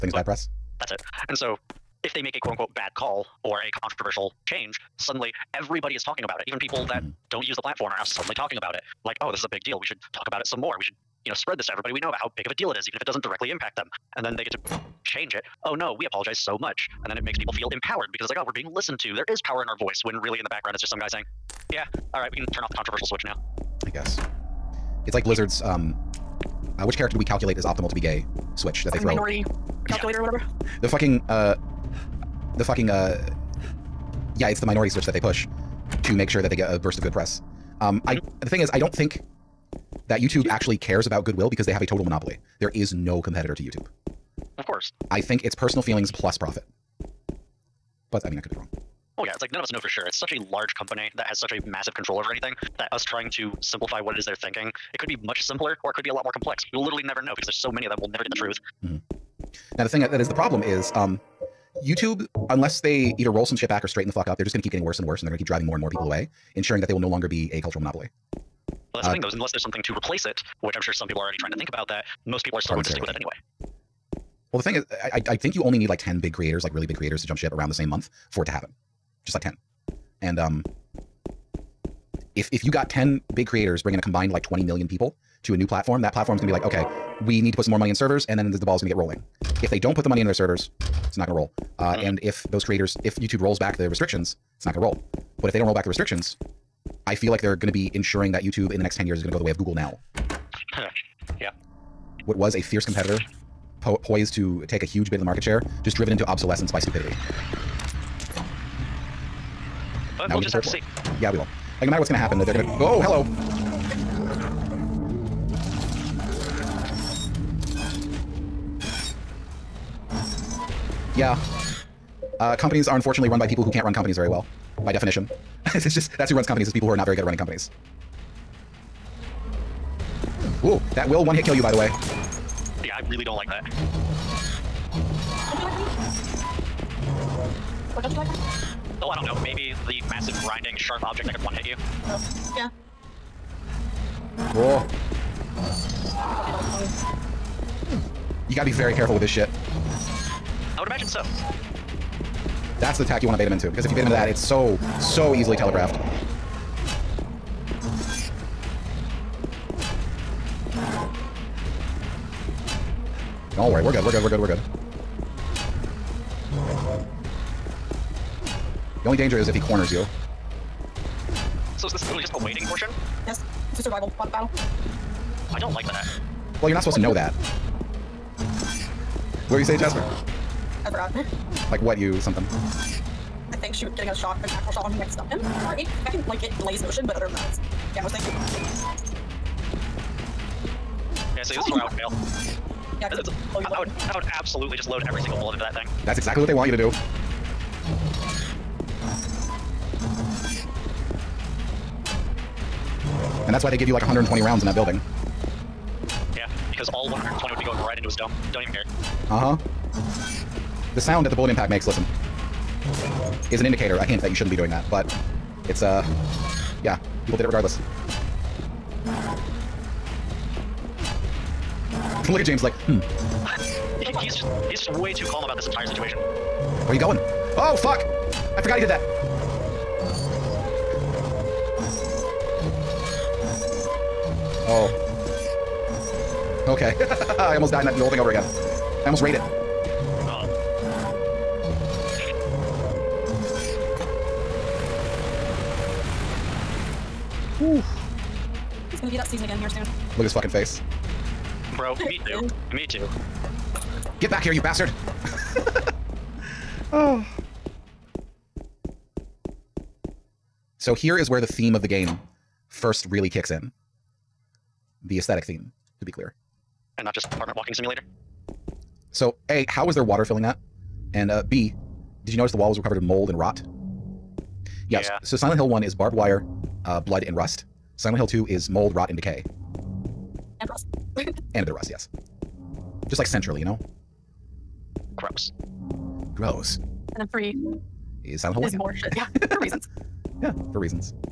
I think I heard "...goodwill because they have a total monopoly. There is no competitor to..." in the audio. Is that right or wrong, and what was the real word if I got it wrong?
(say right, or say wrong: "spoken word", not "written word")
right.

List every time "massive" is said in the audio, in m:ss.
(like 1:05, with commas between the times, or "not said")
0:51, 2:20.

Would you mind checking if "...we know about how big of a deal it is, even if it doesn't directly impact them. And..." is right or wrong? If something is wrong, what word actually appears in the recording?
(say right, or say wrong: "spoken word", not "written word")
right.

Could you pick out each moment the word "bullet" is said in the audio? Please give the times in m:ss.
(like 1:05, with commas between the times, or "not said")
3:15, 3:31.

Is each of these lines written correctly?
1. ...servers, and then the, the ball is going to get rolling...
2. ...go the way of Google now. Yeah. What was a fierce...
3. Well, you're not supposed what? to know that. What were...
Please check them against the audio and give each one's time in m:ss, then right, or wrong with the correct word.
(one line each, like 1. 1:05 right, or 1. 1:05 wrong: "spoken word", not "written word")
1. 1:27 right
2. 1:39 right
3. 2:56 right.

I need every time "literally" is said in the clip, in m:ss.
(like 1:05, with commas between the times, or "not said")
0:56, 2:52.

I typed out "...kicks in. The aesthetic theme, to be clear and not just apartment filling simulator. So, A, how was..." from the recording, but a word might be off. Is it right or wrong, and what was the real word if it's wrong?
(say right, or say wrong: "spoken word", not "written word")
wrong: "walking", not "filling".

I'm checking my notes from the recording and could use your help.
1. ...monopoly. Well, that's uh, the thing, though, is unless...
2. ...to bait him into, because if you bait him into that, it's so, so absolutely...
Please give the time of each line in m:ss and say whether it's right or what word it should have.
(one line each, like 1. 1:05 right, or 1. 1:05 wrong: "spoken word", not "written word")
1. 1:07 right
2. 2:33 wrong: "easily", not "absolutely".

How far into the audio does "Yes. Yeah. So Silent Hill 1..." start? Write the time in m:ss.
4:34.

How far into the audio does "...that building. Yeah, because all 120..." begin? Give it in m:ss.
3:24.